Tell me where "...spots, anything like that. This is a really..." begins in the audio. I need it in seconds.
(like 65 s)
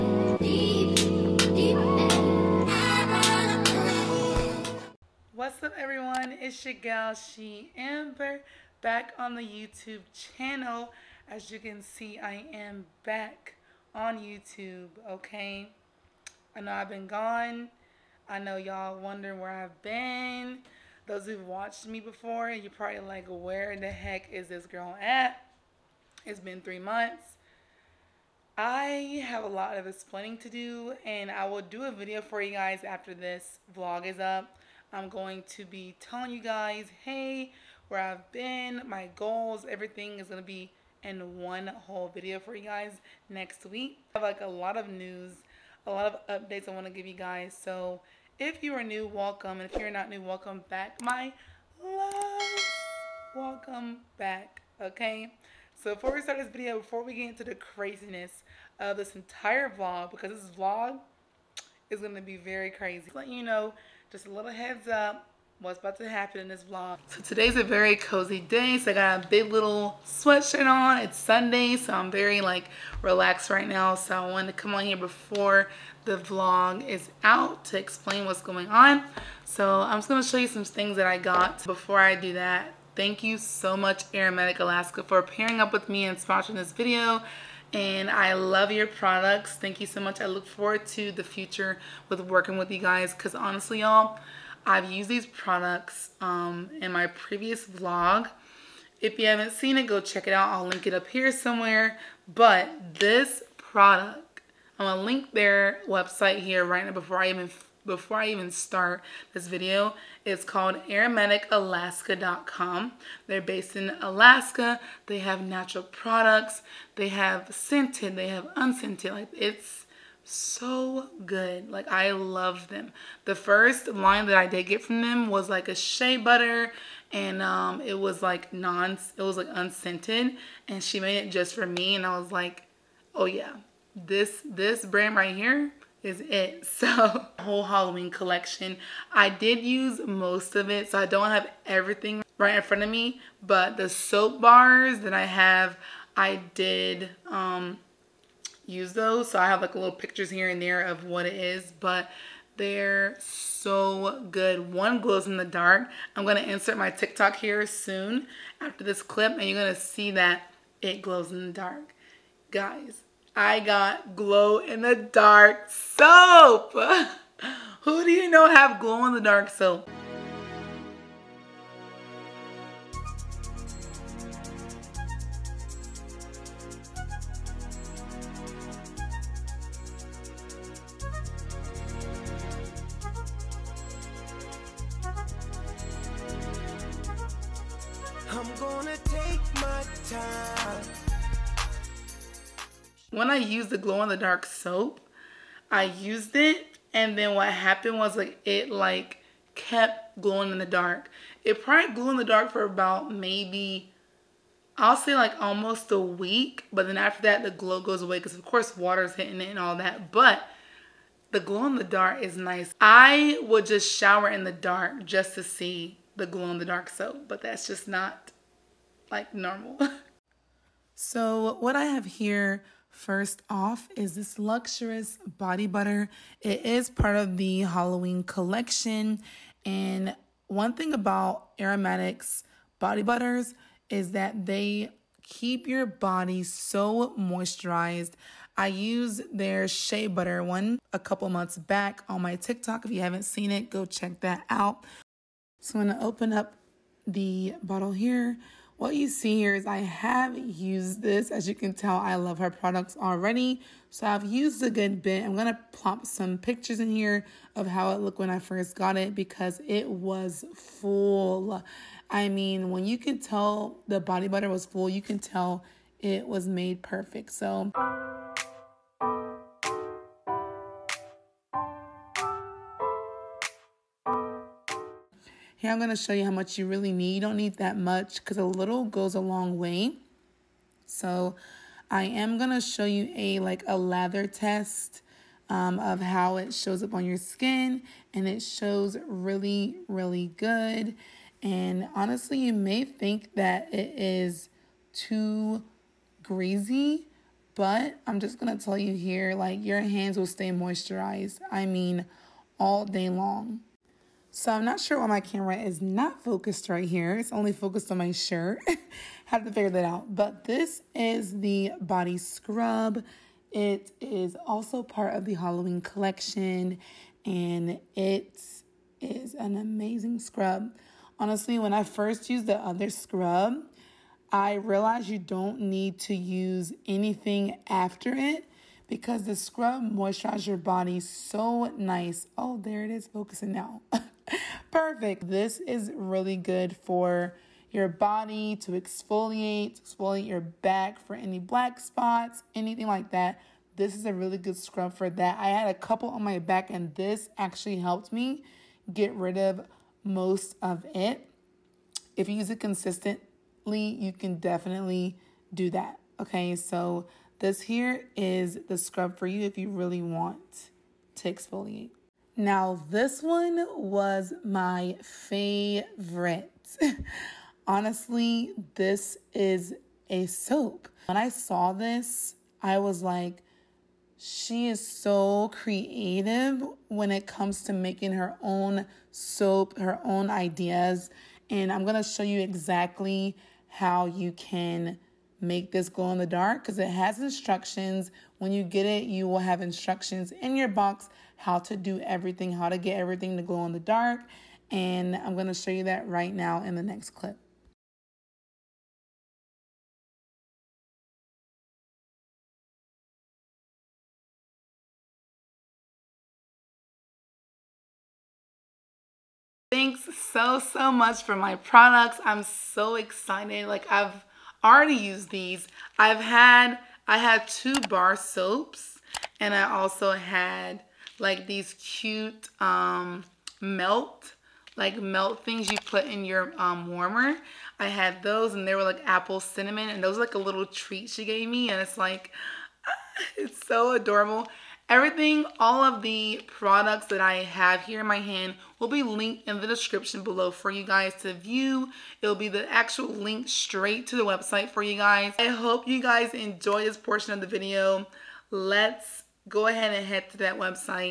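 341 s.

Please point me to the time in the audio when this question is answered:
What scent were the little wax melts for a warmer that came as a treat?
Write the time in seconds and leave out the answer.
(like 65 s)
429 s.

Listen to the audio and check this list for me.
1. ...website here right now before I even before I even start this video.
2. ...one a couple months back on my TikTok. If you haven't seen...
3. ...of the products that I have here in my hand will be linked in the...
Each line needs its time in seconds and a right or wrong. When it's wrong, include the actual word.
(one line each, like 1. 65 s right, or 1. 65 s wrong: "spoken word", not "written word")
1. 105 s right
2. 240 s right
3. 435 s right.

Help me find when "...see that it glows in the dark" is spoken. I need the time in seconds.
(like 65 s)
159 s.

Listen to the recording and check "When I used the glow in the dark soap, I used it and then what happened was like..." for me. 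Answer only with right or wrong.
right.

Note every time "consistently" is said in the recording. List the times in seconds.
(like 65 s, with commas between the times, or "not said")
352 s.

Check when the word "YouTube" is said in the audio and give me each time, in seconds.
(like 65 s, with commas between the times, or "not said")
9 s, 14 s.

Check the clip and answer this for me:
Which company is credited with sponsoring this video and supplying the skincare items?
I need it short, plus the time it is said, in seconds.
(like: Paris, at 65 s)
Aromatic Alaska, at 84 s.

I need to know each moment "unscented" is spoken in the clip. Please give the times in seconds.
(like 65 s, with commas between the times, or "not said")
118 s, 129 s.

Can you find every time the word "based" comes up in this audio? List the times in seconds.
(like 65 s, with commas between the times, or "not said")
113 s.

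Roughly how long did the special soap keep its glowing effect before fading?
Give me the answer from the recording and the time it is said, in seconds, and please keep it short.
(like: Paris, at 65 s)
almost a week, at 205 s.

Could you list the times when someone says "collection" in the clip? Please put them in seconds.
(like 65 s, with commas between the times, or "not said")
138 s, 228 s, 315 s.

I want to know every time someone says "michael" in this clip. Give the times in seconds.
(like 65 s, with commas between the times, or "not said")
not said.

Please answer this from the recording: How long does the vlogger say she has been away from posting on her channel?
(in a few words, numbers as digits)
3 months.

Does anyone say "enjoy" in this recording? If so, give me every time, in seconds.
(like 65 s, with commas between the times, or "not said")
446 s.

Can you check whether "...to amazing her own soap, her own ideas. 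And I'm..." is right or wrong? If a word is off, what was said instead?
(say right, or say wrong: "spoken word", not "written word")
wrong: "making", not "amazing".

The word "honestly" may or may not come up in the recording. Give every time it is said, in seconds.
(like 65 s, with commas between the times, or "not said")
93 s, 291 s, 321 s, 367 s.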